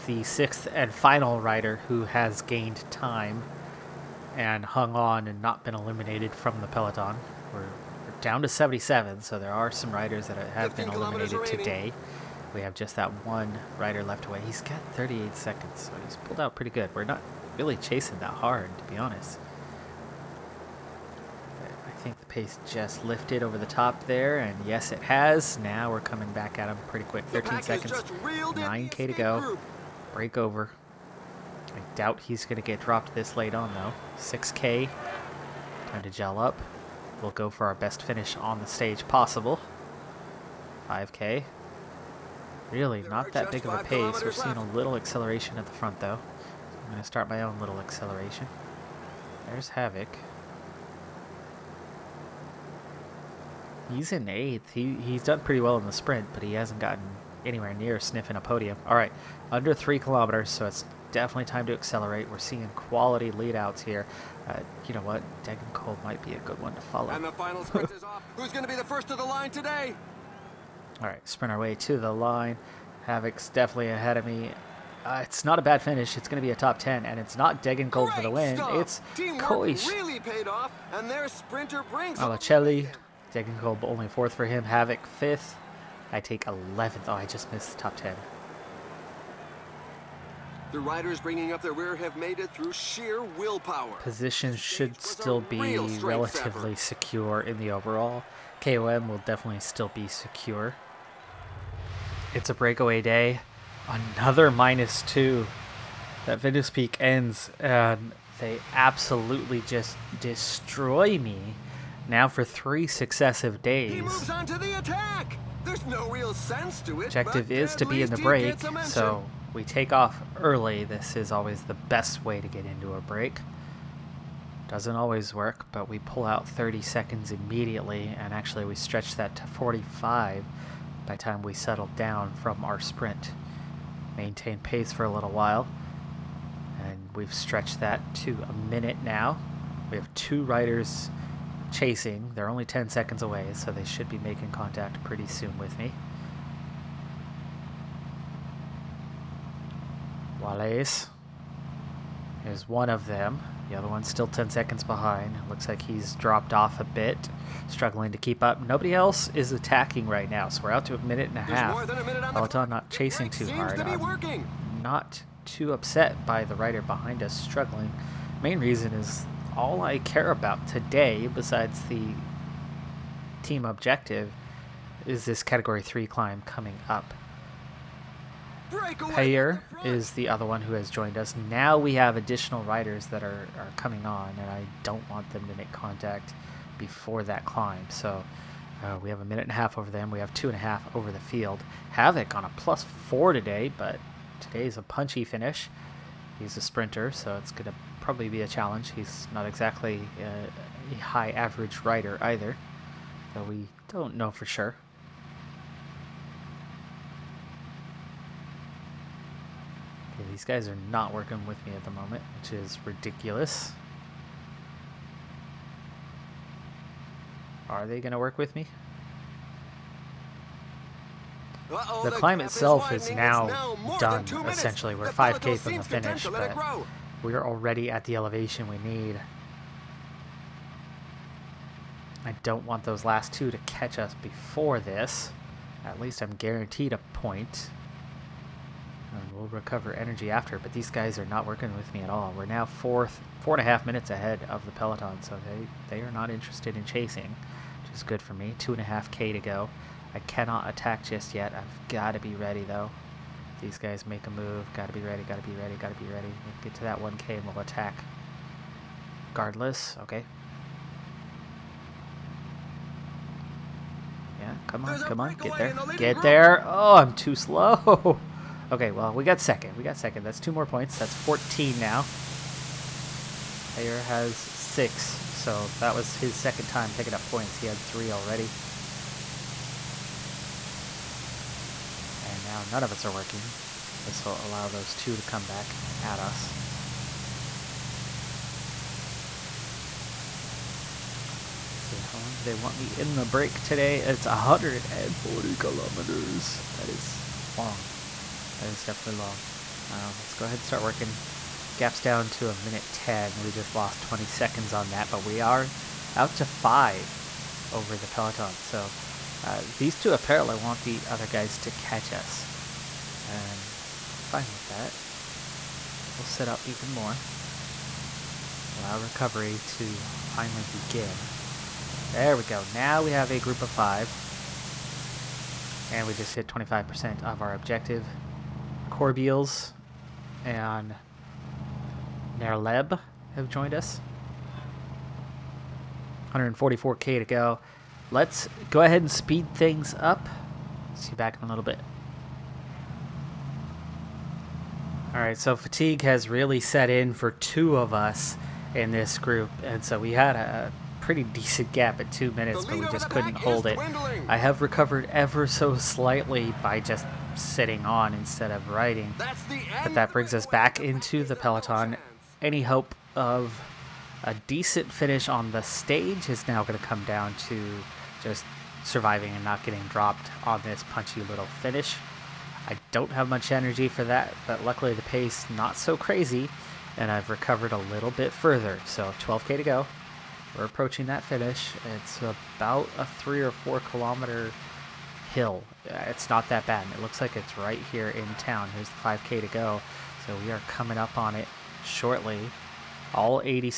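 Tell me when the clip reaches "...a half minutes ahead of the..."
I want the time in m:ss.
4:03.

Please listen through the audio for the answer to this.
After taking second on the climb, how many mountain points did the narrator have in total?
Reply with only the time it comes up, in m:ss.
4:31.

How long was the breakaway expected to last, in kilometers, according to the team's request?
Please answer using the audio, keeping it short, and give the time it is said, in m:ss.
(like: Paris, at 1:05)
140 kilometers, at 4:54.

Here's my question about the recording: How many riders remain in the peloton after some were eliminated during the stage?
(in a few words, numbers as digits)
77.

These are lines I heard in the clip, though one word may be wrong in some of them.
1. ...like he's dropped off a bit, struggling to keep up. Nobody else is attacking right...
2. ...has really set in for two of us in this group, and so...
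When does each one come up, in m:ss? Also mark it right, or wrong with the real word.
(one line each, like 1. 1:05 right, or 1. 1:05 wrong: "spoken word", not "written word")
1. 2:35 right
2. 5:46 right.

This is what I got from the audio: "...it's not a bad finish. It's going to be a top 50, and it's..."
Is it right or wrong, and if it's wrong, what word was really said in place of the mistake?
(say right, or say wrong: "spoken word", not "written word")
wrong: "10", not "50".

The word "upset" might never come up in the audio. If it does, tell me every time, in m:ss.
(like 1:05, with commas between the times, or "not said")
2:45.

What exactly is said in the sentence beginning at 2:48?
Main reason is all I care about today, besides the team objective, is this Category 3 climb coming up.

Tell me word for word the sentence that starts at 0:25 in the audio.
Now we're coming back at him pretty quick.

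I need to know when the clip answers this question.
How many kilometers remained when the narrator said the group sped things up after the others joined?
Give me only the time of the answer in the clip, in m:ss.
5:36.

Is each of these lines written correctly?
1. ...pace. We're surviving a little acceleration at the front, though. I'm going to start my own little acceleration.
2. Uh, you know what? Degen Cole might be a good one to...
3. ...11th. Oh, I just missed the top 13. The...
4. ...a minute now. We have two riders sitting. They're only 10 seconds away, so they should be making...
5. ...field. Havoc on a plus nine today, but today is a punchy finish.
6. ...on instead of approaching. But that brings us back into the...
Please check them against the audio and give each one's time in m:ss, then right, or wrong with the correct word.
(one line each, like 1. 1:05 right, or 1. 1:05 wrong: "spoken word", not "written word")
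1. 0:43 wrong: "seeing", not "surviving"
2. 1:04 right
3. 1:26 wrong: "10", not "13"
4. 2:18 wrong: "chasing", not "sitting"
5. 3:11 wrong: "four", not "nine"
6. 5:57 wrong: "riding", not "approaching".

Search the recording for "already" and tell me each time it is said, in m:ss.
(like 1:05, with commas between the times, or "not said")
3:47, 4:38.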